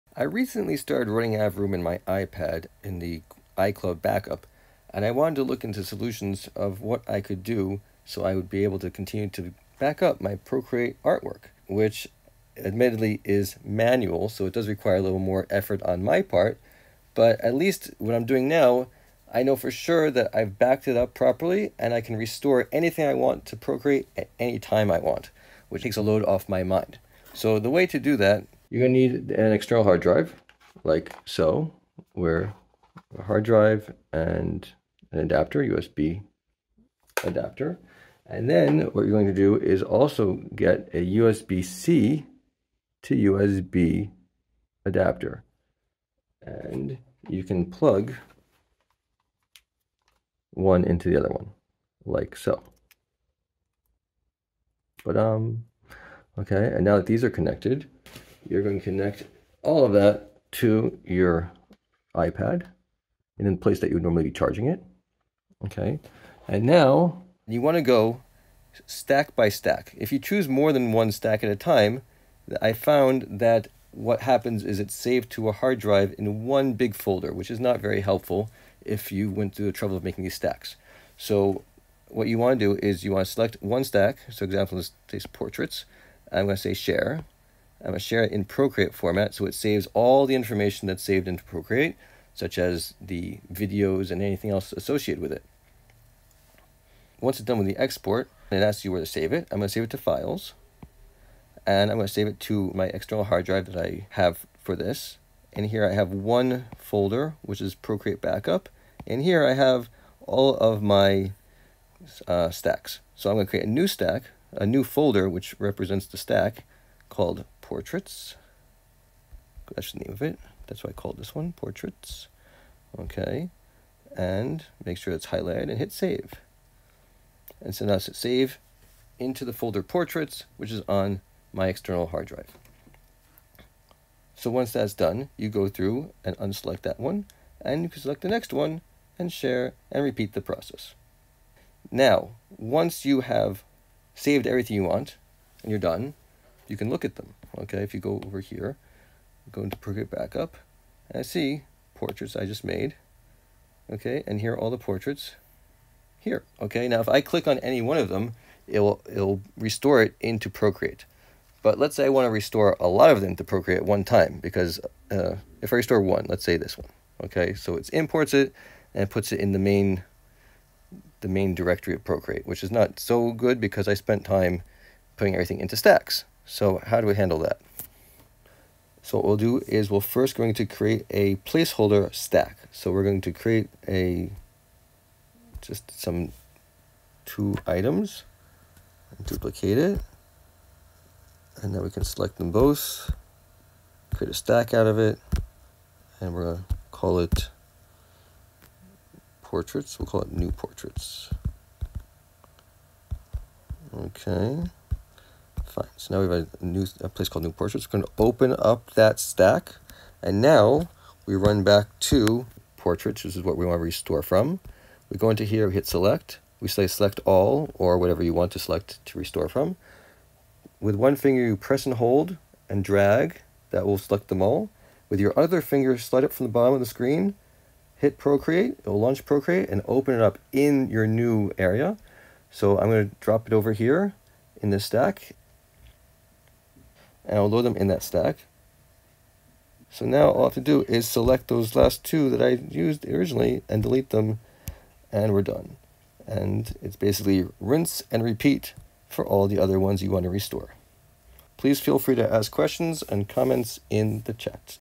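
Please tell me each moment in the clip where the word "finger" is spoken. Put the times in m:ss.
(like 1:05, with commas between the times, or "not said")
3:41, 3:45.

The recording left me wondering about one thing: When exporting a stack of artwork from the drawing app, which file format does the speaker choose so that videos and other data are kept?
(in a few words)
Procreate format.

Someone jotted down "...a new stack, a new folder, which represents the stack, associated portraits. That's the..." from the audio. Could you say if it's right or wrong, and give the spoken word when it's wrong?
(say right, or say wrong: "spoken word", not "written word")
wrong: "called", not "associated".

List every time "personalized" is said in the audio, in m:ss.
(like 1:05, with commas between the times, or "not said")
not said.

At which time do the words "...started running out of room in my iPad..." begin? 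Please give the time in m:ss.
0:00.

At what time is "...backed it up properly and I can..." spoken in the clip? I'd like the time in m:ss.
0:20.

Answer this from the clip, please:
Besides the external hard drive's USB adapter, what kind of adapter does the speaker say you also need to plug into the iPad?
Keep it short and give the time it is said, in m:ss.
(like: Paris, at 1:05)
USB-C to USB adapter, at 0:41.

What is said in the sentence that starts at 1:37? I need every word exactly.
Once it's done with the export, it asks you where to save it.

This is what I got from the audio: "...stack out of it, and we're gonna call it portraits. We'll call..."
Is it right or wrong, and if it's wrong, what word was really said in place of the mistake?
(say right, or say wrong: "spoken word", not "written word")
right.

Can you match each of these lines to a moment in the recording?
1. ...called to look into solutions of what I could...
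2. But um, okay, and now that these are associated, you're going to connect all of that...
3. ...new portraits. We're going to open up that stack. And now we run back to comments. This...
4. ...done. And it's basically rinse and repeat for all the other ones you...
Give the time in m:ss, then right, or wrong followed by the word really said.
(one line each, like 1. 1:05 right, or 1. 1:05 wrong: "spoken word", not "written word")
1. 0:05 wrong: "wanted", not "called"
2. 0:55 wrong: "connected", not "associated"
3. 3:27 wrong: "portraits", not "comments"
4. 4:05 right.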